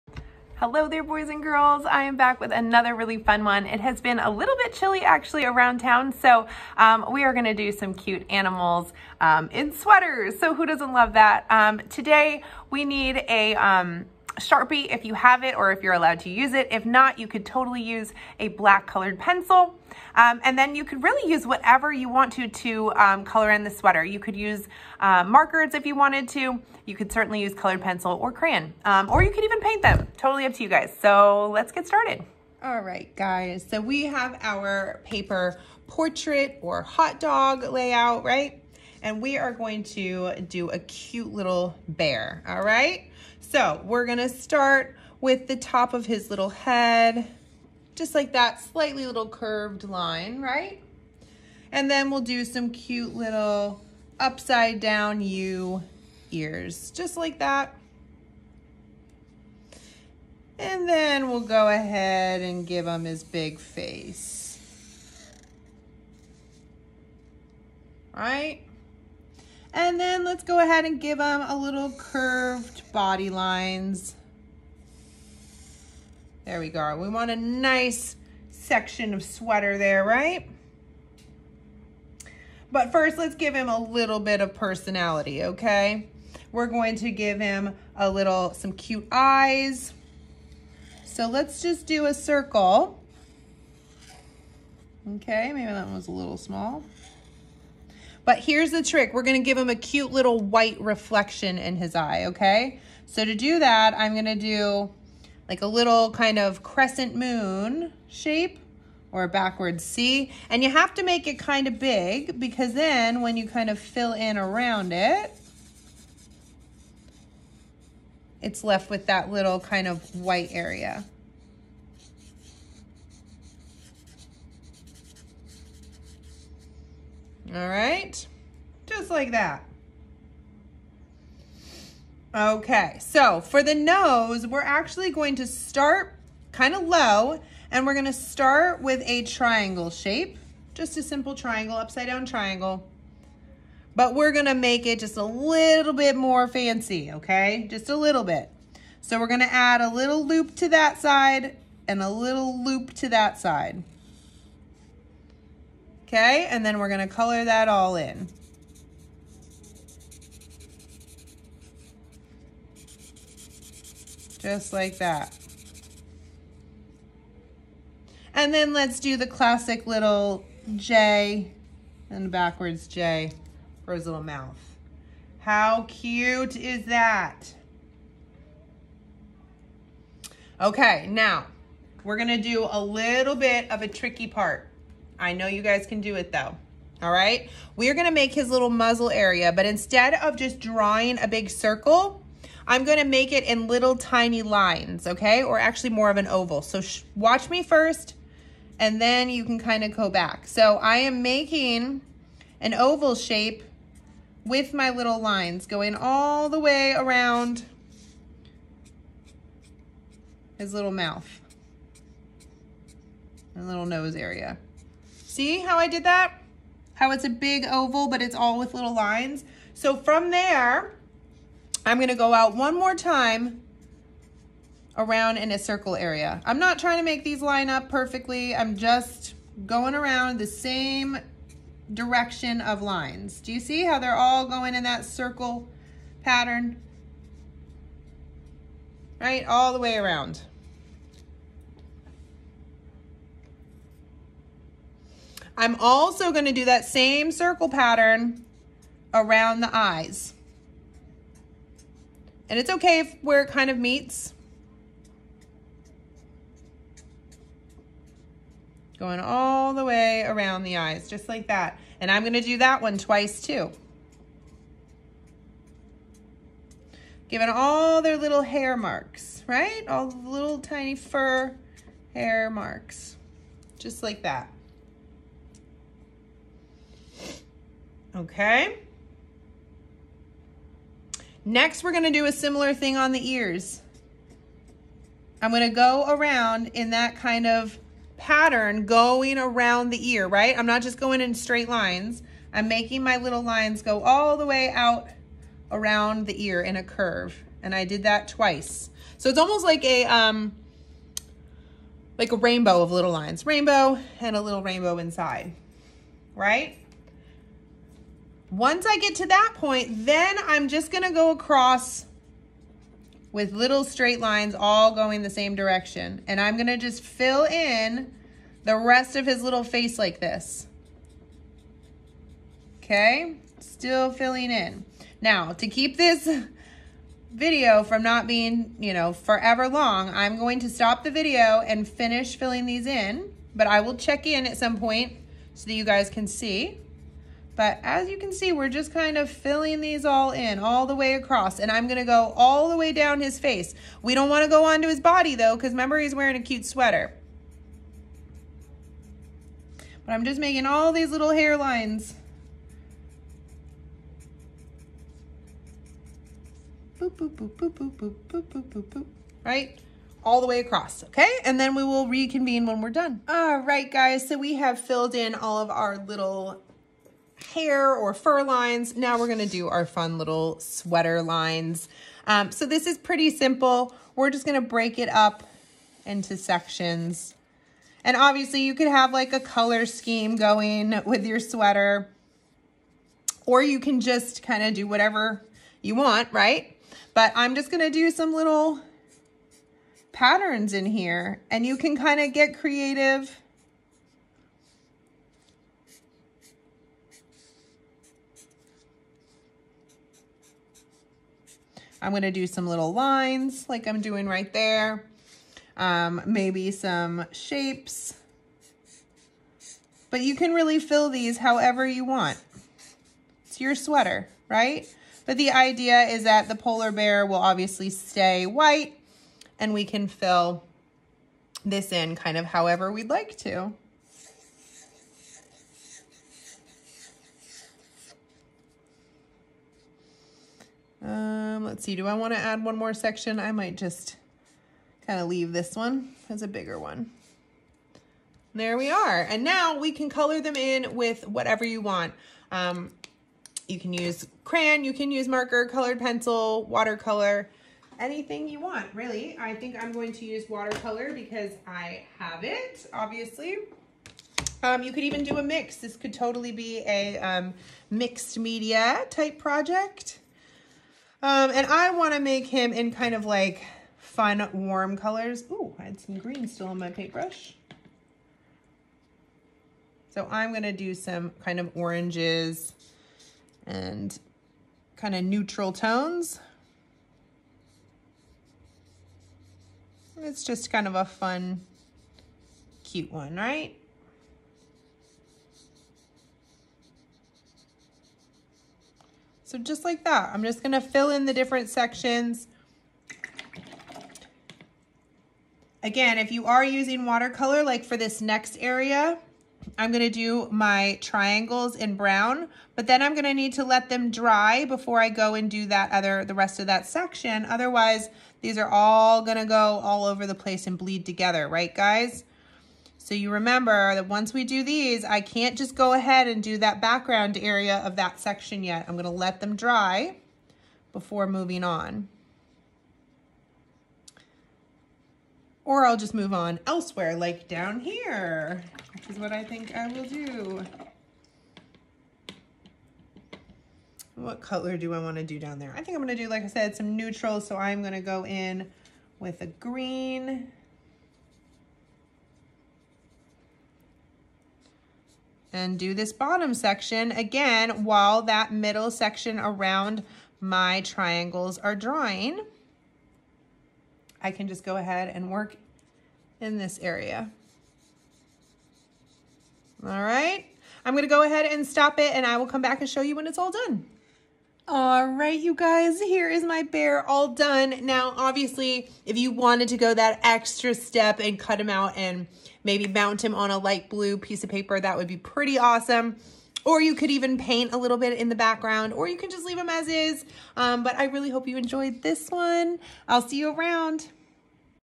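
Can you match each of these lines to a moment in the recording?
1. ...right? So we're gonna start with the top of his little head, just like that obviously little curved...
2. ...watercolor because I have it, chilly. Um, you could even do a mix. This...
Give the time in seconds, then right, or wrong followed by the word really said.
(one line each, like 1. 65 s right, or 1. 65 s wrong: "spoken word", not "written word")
1. 42 s wrong: "slightly", not "obviously"
2. 450 s wrong: "obviously", not "chilly".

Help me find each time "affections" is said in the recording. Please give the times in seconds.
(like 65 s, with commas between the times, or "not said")
not said.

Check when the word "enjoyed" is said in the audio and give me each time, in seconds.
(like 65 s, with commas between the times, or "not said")
581 s.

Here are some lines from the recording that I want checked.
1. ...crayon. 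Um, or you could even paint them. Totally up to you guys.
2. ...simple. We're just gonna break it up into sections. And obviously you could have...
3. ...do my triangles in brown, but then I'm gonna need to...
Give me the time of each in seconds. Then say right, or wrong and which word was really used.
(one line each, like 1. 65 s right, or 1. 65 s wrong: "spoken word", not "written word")
1. 28 s right
2. 373 s right
3. 500 s right.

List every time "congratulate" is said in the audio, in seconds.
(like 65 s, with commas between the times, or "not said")
not said.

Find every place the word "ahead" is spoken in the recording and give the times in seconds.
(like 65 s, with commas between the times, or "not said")
61 s, 70 s, 515 s, 554 s, 561 s.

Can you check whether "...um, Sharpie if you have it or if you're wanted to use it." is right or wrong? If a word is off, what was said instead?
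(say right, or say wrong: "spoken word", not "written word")
wrong: "allowed", not "wanted".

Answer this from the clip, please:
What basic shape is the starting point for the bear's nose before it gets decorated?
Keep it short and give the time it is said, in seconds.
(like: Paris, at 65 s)
upside down triangle, at 141 s.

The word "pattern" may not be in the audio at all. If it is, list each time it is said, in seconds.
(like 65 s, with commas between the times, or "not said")
236 s, 247 s, 288 s, 390 s.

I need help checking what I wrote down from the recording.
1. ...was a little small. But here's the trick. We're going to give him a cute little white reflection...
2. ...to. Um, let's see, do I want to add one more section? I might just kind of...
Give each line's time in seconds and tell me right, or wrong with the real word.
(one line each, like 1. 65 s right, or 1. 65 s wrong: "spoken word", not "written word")
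1. 95 s right
2. 423 s right.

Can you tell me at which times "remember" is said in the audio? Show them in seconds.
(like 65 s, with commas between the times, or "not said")
345 s, 513 s.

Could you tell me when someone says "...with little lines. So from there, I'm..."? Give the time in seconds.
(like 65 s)
218 s.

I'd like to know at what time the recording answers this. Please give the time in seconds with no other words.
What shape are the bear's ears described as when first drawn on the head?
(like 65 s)
54 s.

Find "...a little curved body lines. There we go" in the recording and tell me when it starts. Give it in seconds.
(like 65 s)
71 s.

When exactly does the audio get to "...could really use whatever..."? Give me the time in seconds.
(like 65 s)
20 s.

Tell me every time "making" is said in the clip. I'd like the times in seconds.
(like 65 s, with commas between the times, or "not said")
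201 s, 292 s, 350 s.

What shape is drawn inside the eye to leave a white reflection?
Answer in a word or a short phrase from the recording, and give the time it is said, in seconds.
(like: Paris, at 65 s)
crescent moon shape, at 106 s.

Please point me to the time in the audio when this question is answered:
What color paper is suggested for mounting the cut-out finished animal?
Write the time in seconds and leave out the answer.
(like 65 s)
573 s.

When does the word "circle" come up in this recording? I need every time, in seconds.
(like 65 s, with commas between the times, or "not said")
92 s, 191 s, 225 s, 235 s, 247 s.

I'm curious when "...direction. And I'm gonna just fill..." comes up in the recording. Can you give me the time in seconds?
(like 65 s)
315 s.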